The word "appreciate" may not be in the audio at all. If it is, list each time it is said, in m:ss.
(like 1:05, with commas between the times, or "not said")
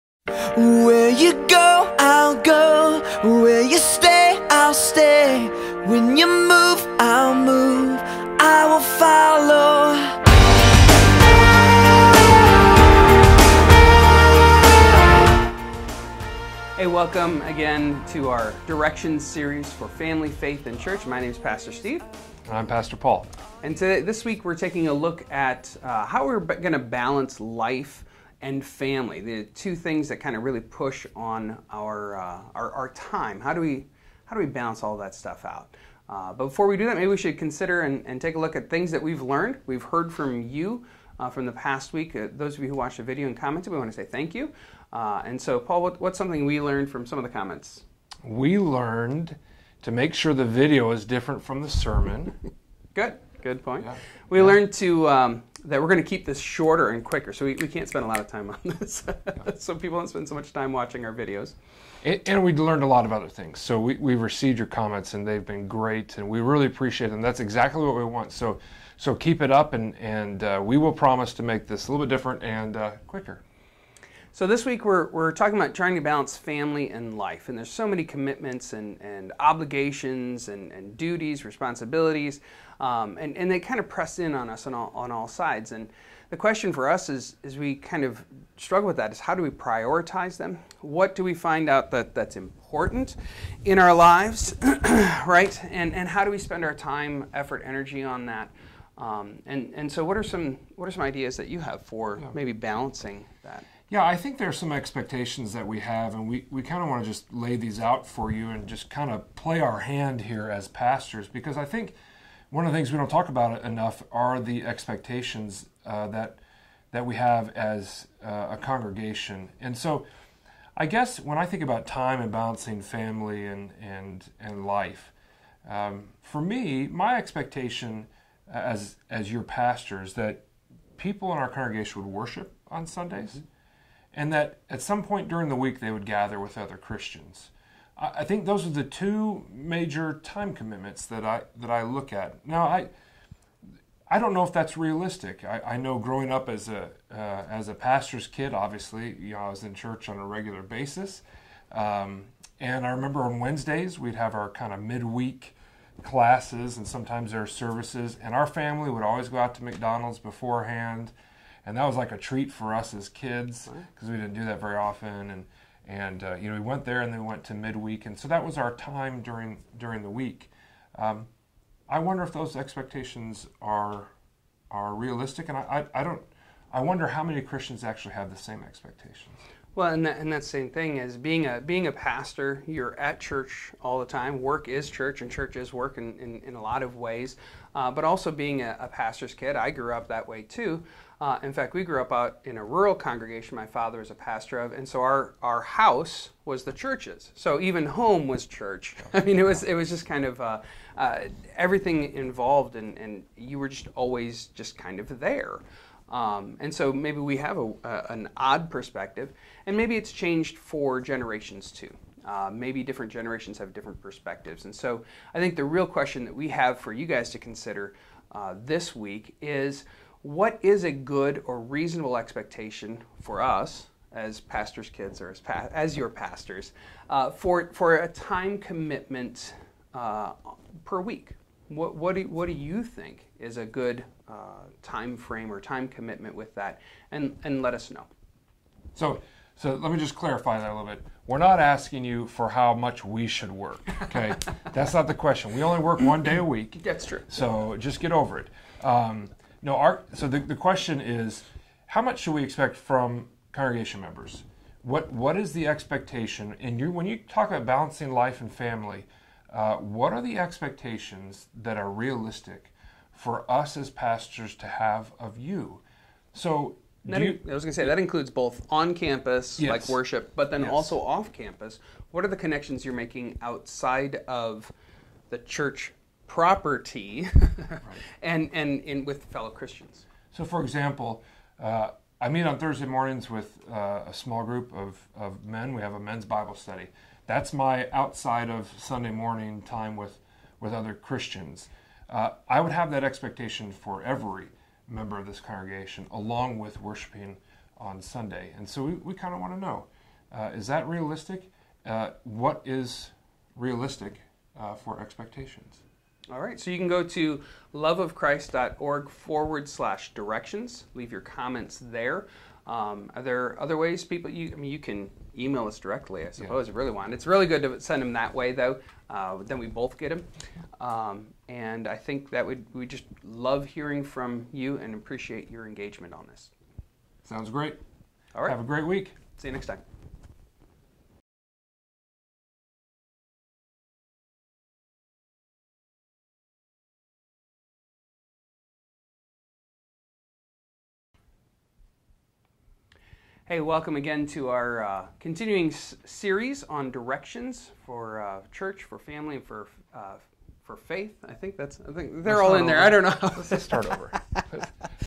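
1:06, 5:24.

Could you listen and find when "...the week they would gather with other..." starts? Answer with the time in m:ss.
2:15.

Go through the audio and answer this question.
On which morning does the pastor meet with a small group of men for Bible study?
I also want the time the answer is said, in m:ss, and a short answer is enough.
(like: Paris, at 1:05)
Thursday, at 4:42.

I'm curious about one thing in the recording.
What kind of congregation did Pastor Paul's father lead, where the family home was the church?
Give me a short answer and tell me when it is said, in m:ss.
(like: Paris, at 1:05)
rural congregation, at 3:12.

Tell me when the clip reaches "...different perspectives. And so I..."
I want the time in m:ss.
3:33.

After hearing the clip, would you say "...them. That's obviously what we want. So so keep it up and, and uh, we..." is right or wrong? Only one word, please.
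wrong.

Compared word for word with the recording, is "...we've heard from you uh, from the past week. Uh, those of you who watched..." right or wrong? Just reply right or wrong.
right.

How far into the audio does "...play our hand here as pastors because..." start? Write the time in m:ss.
1:49.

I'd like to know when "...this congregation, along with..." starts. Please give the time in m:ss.
4:55.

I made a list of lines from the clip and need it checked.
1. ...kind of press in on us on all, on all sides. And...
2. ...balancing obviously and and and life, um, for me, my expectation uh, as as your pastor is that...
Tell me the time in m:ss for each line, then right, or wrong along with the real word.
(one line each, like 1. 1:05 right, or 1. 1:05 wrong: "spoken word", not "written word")
1. 1:23 right
2. 2:02 wrong: "family", not "obviously".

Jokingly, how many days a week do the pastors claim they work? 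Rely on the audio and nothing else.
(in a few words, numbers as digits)
1.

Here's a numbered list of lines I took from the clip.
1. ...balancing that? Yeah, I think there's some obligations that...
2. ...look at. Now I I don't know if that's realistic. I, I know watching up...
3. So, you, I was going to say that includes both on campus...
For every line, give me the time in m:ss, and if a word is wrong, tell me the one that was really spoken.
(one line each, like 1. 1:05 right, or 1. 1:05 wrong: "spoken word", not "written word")
1. 1:42 wrong: "expectations", not "obligations"
2. 2:21 wrong: "growing", not "watching"
3. 4:26 right.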